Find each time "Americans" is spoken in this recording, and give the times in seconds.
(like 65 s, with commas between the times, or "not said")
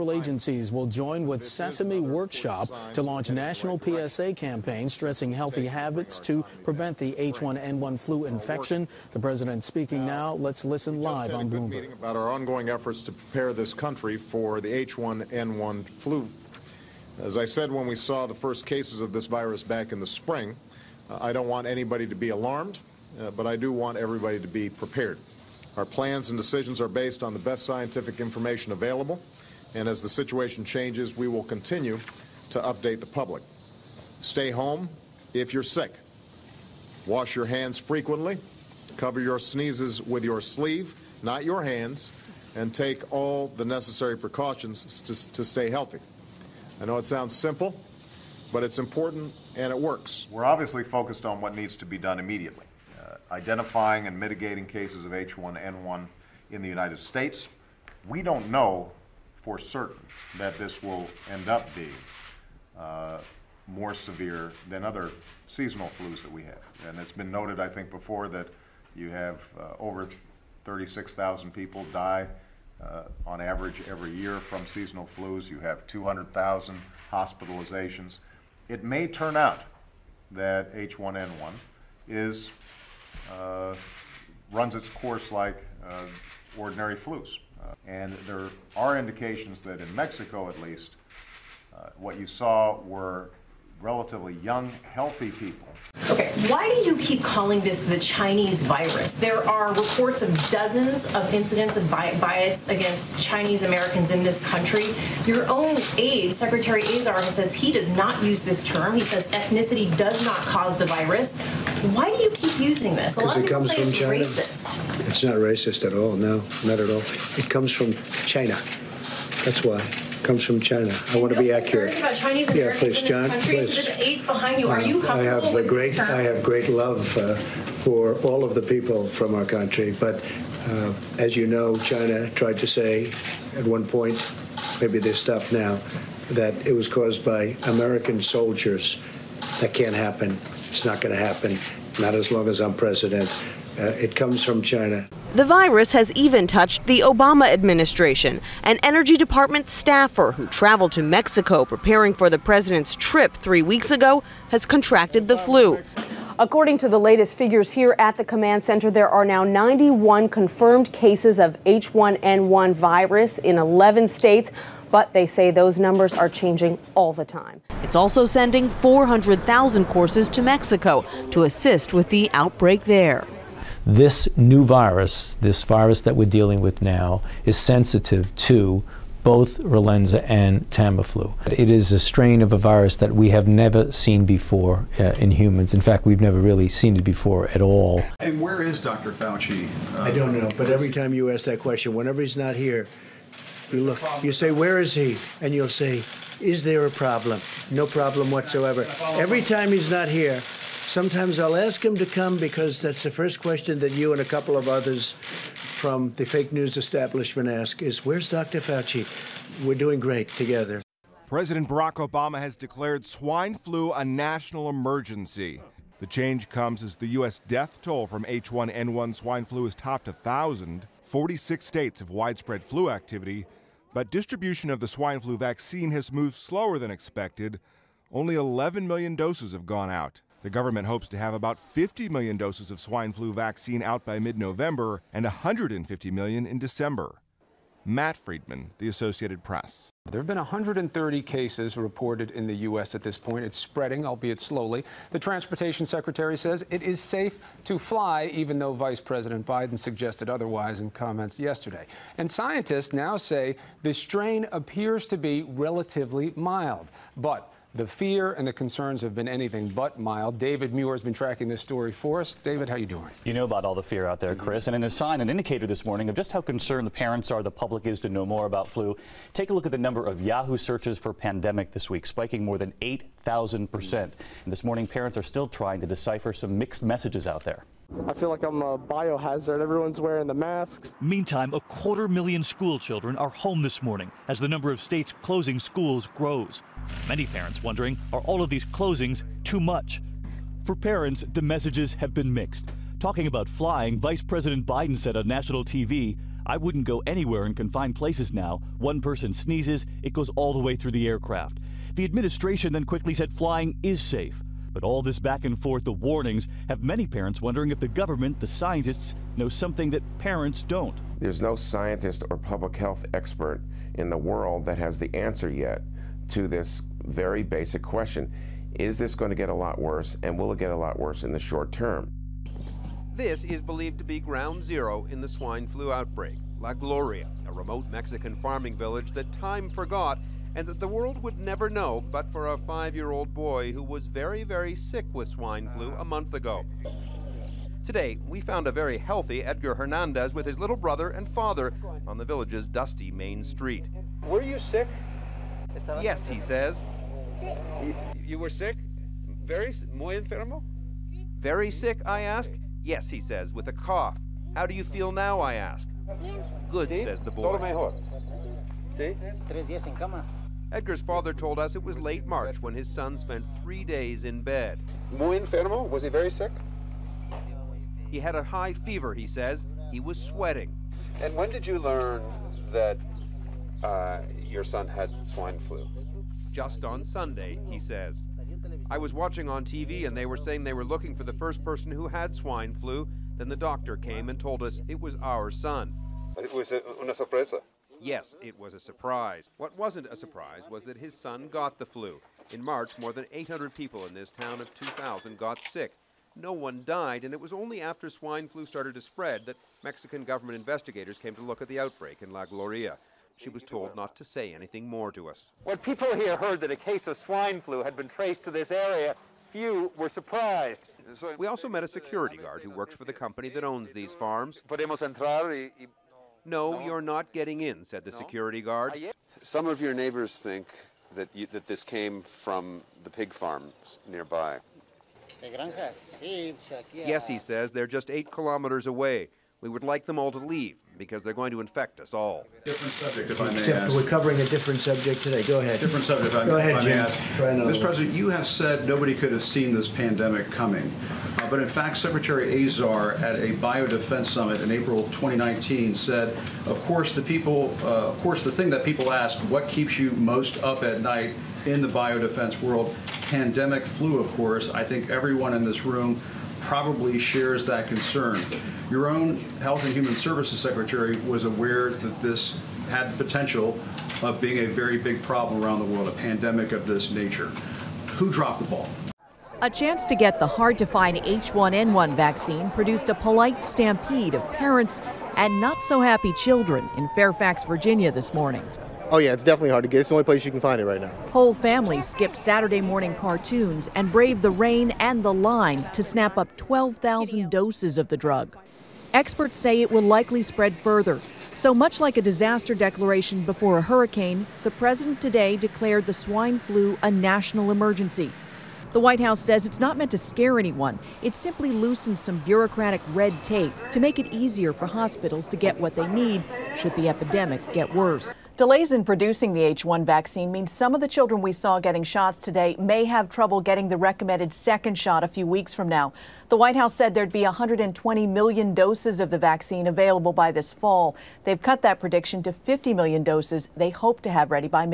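103 s, 137 s.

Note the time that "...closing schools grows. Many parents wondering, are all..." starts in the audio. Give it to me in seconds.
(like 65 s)
285 s.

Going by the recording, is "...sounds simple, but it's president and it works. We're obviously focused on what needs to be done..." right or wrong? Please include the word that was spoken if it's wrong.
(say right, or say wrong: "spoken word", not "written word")
wrong: "important", not "president".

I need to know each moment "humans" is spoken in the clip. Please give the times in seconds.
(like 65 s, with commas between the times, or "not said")
185 s, 459 s.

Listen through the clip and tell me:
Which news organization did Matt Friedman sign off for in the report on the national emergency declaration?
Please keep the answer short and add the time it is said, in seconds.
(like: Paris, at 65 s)
The Associated Press, at 238 s.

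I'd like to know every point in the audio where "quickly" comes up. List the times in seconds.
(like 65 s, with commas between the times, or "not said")
302 s.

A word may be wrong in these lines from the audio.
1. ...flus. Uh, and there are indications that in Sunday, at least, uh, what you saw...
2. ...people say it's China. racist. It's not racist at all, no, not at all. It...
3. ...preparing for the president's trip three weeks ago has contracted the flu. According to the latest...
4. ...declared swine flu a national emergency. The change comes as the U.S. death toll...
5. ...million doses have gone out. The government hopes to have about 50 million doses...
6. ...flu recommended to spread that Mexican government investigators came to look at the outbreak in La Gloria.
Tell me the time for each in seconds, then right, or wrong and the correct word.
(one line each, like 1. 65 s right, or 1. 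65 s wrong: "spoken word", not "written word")
1. 86 s wrong: "Mexico", not "Sunday"
2. 113 s right
3. 151 s right
4. 212 s right
5. 228 s right
6. 398 s wrong: "started", not "recommended".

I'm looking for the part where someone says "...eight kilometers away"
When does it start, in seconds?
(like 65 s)
428 s.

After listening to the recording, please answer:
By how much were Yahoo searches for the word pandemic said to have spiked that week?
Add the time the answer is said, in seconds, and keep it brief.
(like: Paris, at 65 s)
8,000 percent, at 272 s.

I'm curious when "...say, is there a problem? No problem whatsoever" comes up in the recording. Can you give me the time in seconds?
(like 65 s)
195 s.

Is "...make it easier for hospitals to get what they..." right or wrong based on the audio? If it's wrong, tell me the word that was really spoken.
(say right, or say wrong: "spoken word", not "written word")
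right.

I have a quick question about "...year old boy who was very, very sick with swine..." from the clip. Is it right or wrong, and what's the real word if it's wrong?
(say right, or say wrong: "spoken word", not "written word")
right.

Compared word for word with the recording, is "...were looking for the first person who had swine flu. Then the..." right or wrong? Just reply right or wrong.
right.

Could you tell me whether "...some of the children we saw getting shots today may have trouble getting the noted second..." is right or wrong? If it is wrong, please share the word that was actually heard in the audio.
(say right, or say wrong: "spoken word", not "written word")
wrong: "recommended", not "noted".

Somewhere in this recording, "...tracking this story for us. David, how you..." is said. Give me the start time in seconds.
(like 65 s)
261 s.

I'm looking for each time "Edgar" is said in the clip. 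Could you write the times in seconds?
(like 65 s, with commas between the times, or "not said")
339 s, 360 s.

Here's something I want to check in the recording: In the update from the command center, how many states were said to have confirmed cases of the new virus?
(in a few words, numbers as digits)
11.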